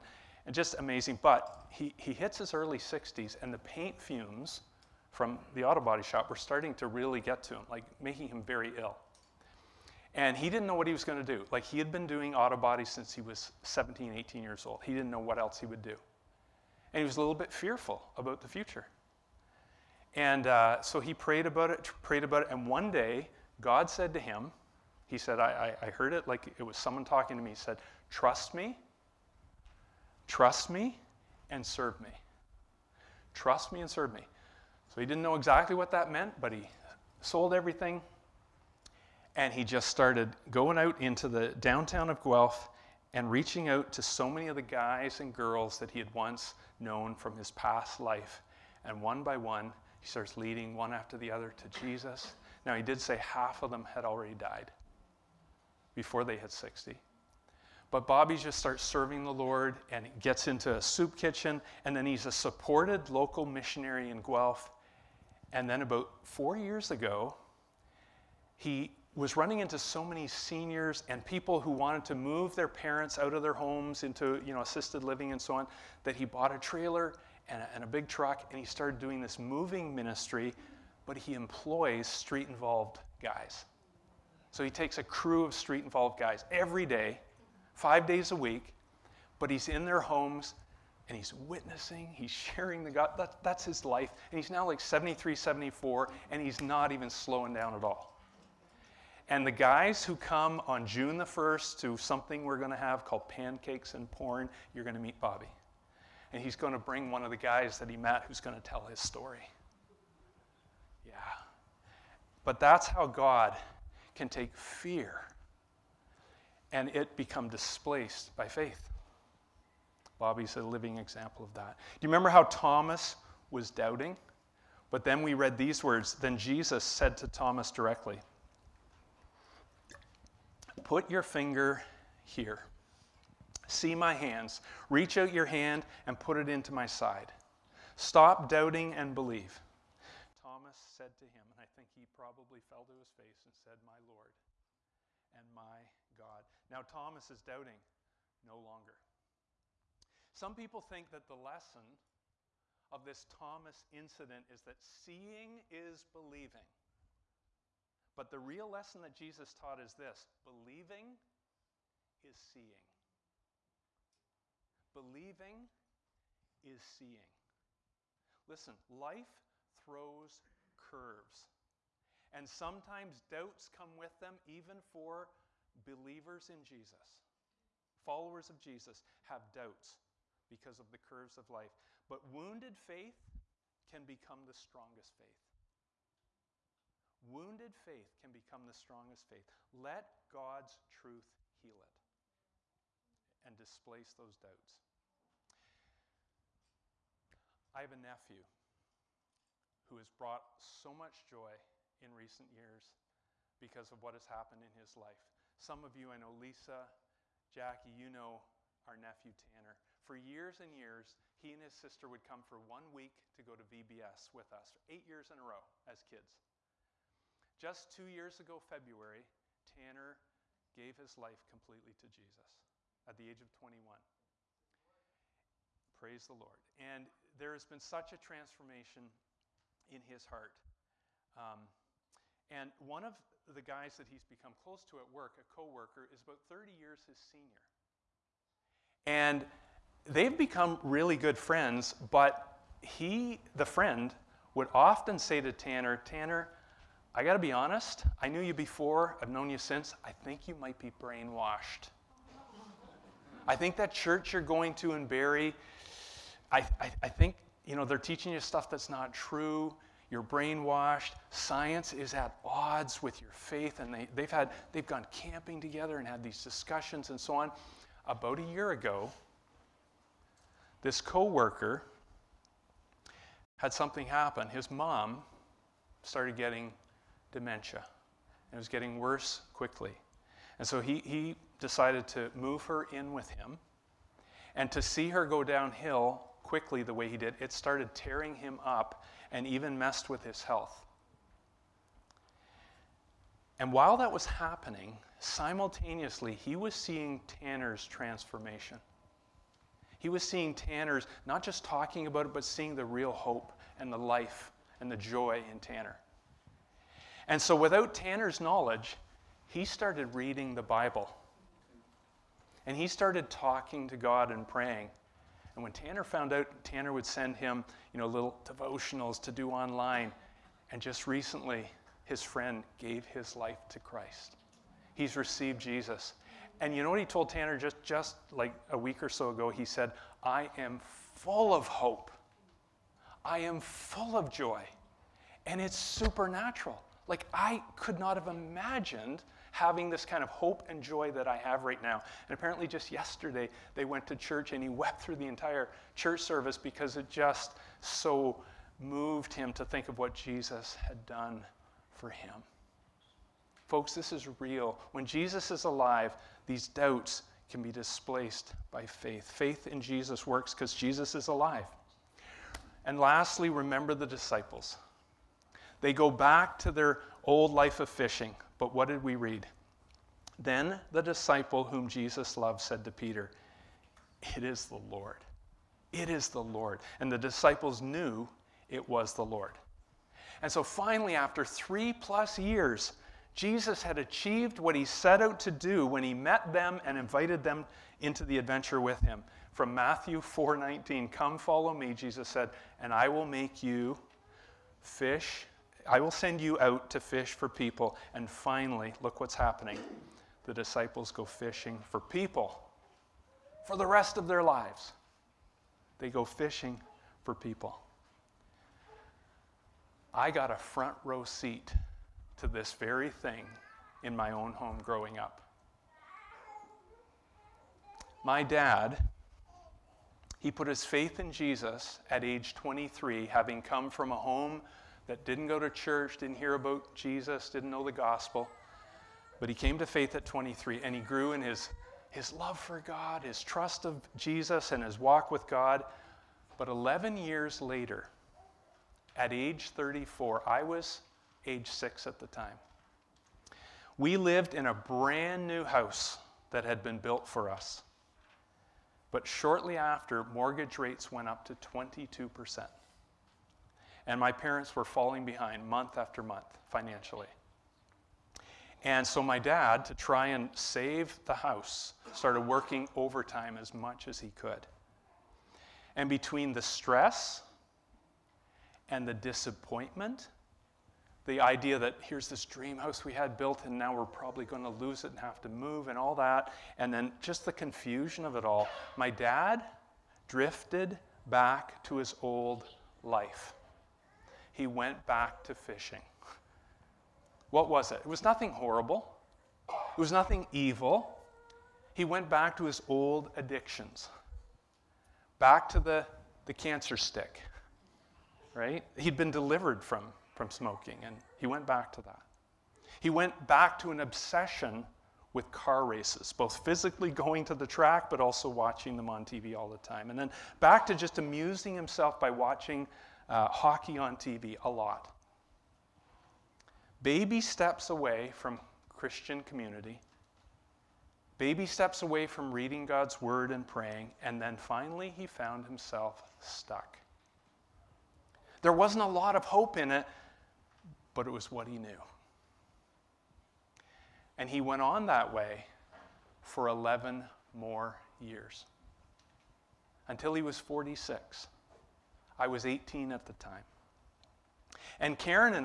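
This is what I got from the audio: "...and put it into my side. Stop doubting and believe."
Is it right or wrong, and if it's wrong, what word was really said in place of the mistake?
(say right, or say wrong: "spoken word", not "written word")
right.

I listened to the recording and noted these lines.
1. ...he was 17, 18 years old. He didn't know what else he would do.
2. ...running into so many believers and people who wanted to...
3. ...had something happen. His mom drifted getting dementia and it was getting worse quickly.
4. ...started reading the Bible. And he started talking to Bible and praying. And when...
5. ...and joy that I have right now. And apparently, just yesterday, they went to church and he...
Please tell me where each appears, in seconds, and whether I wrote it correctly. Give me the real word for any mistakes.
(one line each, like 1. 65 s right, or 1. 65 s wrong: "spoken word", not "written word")
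1. 13 s right
2. 69 s wrong: "seniors", not "believers"
3. 273 s wrong: "started", not "drifted"
4. 309 s wrong: "God", not "Bible"
5. 340 s right.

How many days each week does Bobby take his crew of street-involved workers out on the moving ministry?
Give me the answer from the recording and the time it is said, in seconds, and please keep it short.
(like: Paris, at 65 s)
5, at 87 s.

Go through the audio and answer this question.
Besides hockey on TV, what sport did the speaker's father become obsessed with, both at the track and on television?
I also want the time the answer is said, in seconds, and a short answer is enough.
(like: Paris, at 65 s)
Car races, at 505 s.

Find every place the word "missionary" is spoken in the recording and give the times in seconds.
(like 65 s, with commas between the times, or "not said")
63 s.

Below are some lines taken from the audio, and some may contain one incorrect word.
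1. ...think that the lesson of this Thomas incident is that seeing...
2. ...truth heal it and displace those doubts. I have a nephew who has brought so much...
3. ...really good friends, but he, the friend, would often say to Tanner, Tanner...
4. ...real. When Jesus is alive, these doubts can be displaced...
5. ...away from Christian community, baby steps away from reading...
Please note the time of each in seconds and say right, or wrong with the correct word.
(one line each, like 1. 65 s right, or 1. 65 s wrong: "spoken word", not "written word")
1. 150 s right
2. 190 s right
3. 240 s right
4. 354 s right
5. 517 s right.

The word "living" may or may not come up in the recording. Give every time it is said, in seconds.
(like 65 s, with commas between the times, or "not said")
75 s, 120 s.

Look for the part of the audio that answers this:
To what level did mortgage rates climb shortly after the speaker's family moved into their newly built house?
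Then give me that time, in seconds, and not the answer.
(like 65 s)
451 s.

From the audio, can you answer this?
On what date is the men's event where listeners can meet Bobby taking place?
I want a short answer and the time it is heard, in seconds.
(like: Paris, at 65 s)
June 1, at 100 s.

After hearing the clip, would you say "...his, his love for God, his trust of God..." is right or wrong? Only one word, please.
wrong.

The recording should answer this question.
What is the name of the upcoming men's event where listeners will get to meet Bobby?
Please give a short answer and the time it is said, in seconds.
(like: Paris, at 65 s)
Pancakes and Porn, at 103 s.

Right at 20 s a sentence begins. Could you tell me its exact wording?
And uh, so he prayed about it, prayed about it.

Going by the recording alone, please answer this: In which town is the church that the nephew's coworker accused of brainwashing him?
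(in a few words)
Barrie.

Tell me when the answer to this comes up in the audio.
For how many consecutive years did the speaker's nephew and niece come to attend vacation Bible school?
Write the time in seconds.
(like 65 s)
214 s.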